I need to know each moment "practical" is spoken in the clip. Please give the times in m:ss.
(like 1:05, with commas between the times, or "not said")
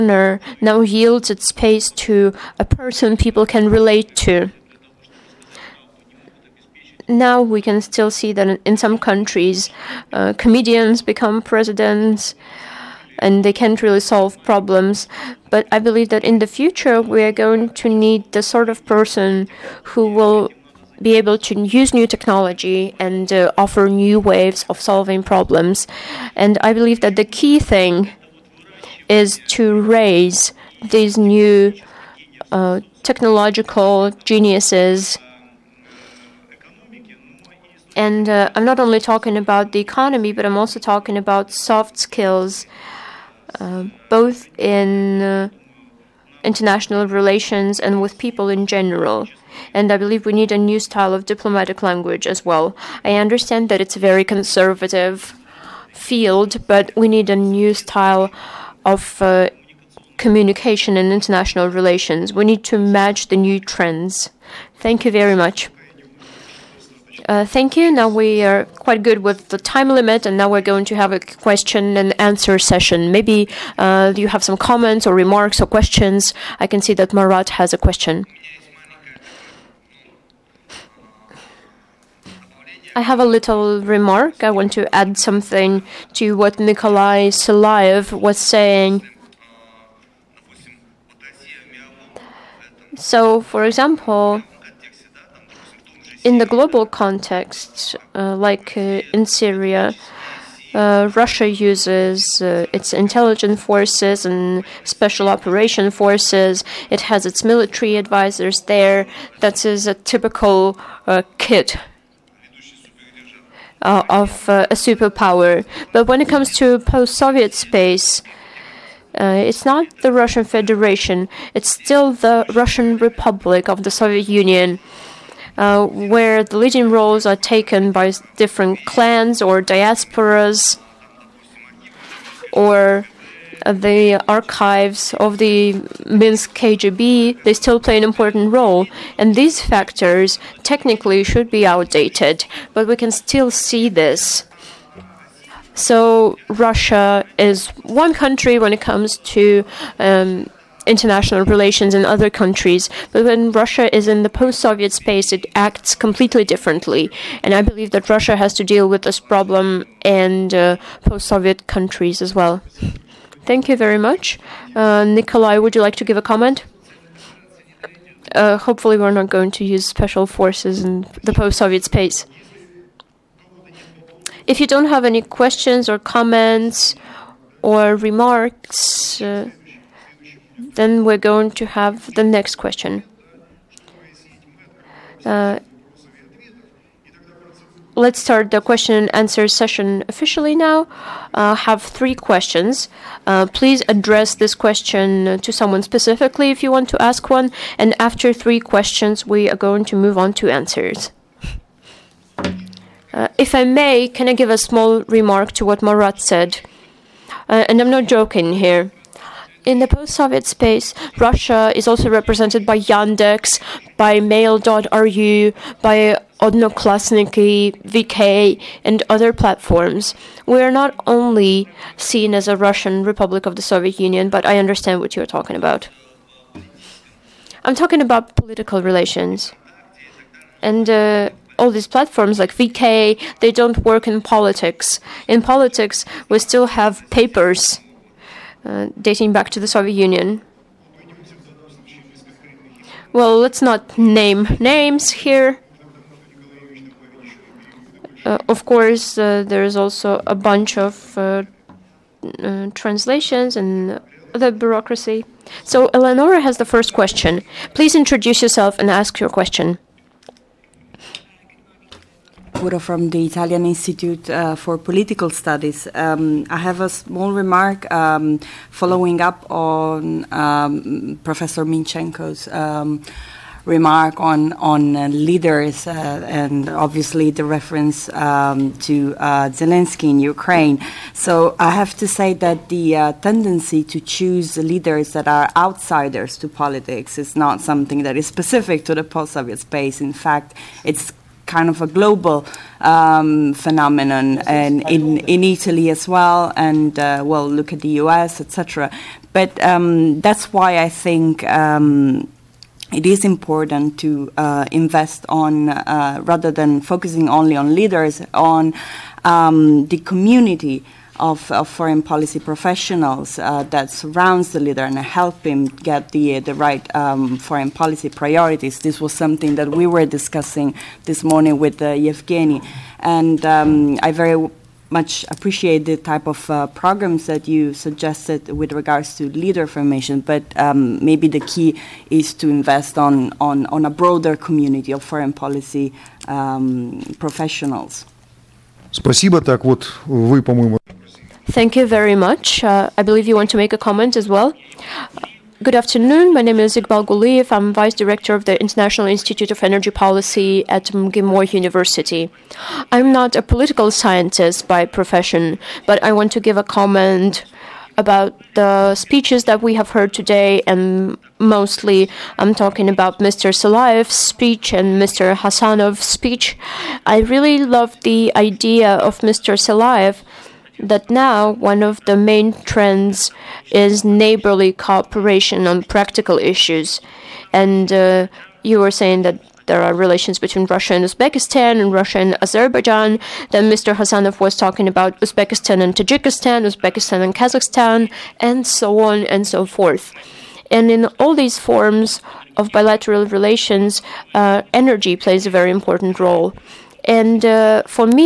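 6:15.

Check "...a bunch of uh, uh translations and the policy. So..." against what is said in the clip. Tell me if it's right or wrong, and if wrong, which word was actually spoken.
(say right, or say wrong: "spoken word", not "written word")
wrong: "bureaucracy", not "policy".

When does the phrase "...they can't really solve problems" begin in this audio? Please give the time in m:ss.
0:13.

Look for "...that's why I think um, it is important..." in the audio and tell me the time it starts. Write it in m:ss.
5:00.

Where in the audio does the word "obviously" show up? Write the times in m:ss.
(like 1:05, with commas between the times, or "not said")
4:36.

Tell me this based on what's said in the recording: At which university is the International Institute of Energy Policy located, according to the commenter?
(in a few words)
MGIMO University.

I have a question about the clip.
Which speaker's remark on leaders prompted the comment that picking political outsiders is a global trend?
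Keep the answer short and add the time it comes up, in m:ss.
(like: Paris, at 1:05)
Professor Minchenko, at 4:31.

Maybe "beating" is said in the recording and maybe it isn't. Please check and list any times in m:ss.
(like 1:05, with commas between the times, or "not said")
not said.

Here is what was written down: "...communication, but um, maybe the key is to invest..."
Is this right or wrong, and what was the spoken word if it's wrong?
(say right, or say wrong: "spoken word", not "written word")
wrong: "formation", not "communication".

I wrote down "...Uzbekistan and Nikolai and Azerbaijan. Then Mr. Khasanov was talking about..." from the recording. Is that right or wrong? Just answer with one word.
wrong.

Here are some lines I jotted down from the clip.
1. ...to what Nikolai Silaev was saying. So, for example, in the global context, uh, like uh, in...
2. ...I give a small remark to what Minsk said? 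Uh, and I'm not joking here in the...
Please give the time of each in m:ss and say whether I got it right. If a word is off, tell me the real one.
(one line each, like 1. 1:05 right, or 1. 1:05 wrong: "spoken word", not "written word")
1. 1:26 right
2. 3:24 wrong: "Marat", not "Minsk".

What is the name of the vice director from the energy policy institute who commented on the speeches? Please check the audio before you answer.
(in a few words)
Iqbal Guliev.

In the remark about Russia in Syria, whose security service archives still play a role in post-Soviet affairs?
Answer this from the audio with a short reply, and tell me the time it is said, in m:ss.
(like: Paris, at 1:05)
Minsk KGB, at 2:16.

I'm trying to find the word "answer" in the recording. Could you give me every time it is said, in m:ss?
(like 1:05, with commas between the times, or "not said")
1:12, 3:09, 3:20.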